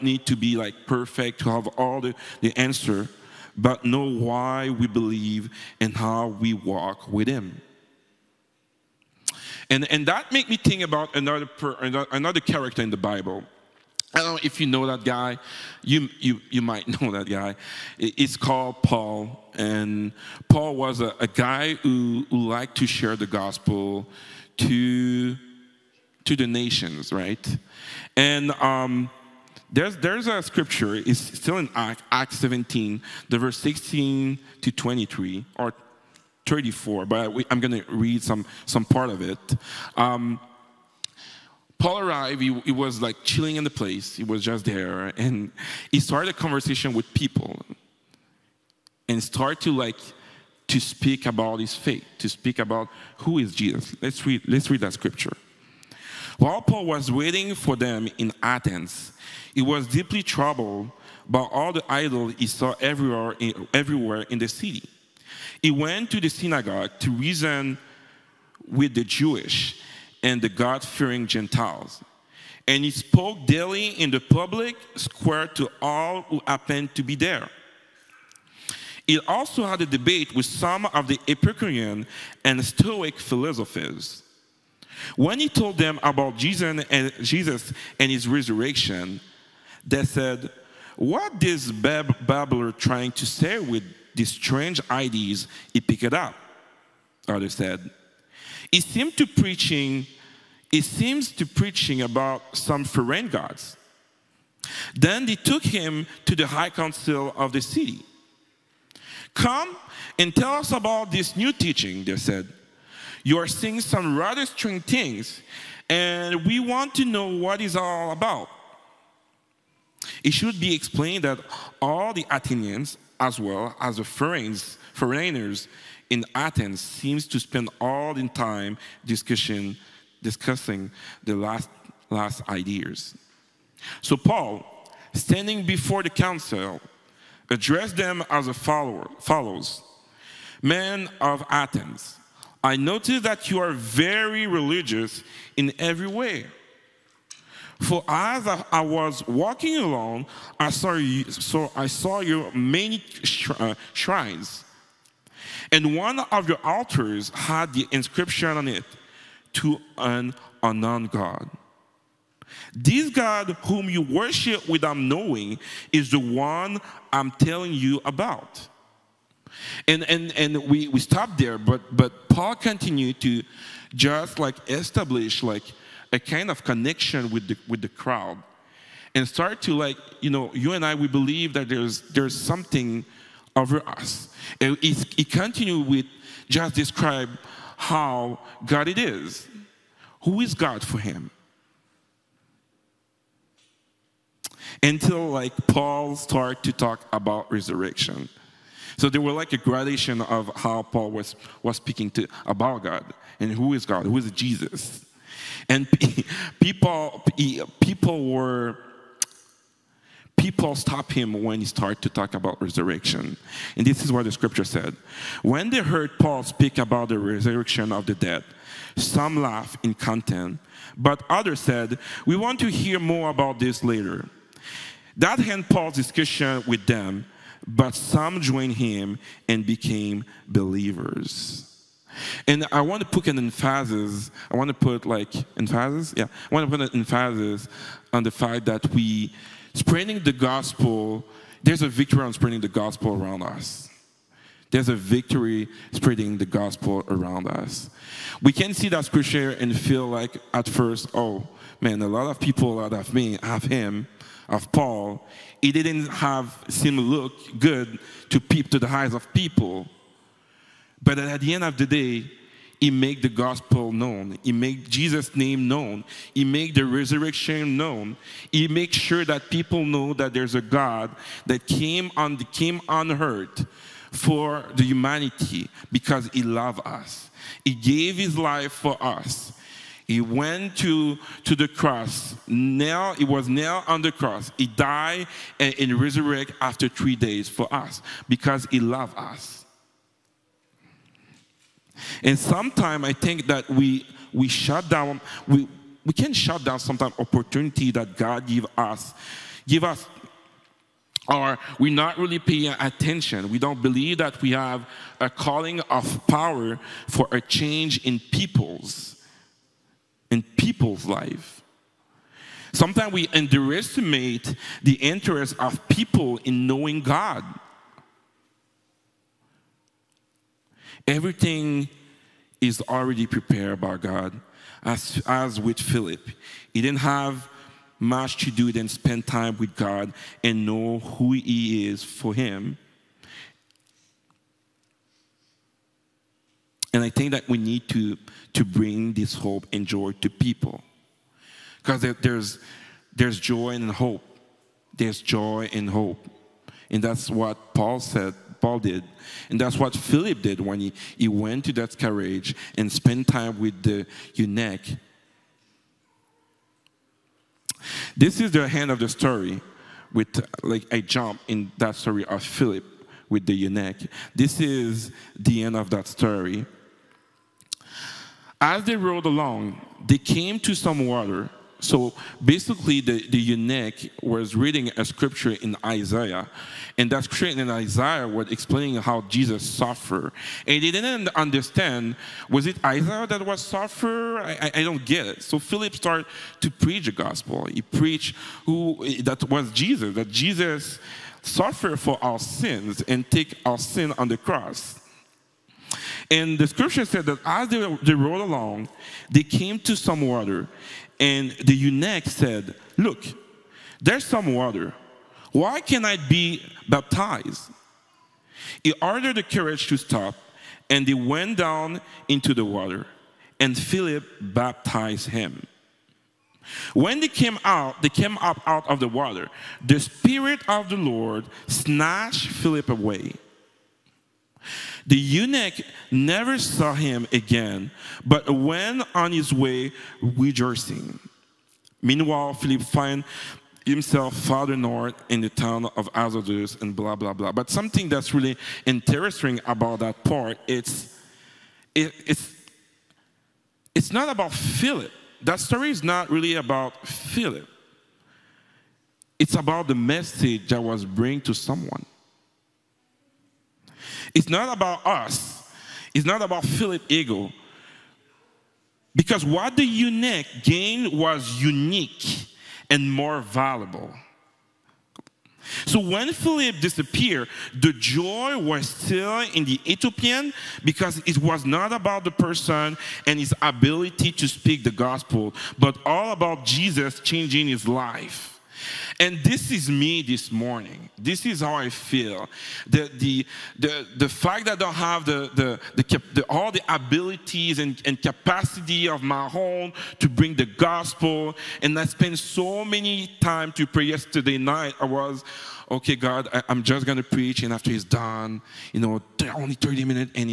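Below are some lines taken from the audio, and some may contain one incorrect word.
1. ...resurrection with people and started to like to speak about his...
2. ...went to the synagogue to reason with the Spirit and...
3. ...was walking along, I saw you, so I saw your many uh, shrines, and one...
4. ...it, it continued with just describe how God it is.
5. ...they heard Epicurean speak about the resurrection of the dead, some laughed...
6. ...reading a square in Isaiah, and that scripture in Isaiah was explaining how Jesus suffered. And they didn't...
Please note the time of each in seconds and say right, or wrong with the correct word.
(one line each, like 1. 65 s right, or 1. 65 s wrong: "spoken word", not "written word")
1. 46 s wrong: "conversation", not "resurrection"
2. 65 s wrong: "Jewish", not "Spirit"
3. 148 s right
4. 184 s right
5. 215 s wrong: "Paul", not "Epicurean"
6. 374 s wrong: "scripture", not "square".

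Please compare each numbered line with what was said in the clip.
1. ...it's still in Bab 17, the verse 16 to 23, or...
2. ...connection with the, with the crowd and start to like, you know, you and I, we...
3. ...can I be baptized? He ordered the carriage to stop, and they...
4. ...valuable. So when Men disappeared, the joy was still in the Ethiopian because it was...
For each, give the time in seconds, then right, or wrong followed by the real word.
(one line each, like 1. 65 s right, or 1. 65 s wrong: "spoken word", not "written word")
1. 30 s wrong: "Acts", not "Bab"
2. 176 s right
3. 405 s right
4. 463 s wrong: "Philip", not "Men".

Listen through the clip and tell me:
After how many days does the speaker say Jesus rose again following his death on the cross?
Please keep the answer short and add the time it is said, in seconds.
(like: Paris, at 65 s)
3, at 286 s.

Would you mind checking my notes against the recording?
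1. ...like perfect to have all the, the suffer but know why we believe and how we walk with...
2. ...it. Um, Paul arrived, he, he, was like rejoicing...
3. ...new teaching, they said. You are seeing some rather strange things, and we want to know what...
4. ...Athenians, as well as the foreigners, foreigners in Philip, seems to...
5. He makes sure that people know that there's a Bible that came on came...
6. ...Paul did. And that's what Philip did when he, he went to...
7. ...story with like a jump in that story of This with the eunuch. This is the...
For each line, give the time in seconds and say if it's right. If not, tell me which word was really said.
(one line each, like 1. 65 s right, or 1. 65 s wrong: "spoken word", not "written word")
1. 0 s wrong: "answer", not "suffer"
2. 39 s wrong: "chilling", not "rejoicing"
3. 111 s right
4. 122 s wrong: "Athens", not "Philip"
5. 268 s wrong: "God", not "Bible"
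6. 348 s right
7. 359 s wrong: "Philip", not "This".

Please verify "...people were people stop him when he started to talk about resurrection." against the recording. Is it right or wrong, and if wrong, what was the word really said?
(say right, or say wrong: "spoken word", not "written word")
right.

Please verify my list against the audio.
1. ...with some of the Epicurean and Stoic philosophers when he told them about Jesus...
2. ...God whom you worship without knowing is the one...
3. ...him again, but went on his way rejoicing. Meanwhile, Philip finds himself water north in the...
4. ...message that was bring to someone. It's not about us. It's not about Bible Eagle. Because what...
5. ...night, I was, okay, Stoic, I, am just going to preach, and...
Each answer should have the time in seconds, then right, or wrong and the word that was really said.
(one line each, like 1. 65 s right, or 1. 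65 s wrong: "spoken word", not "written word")
1. 80 s right
2. 163 s right
3. 426 s wrong: "farther", not "water"
4. 449 s wrong: "Philip", not "Bible"
5. 494 s wrong: "God", not "Stoic".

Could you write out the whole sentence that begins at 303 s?
We don't believe that we have a calling of power for a change in peoples in people's life.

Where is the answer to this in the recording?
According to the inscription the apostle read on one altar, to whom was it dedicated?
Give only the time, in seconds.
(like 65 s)
159 s.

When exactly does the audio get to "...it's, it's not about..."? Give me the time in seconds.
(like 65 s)
442 s.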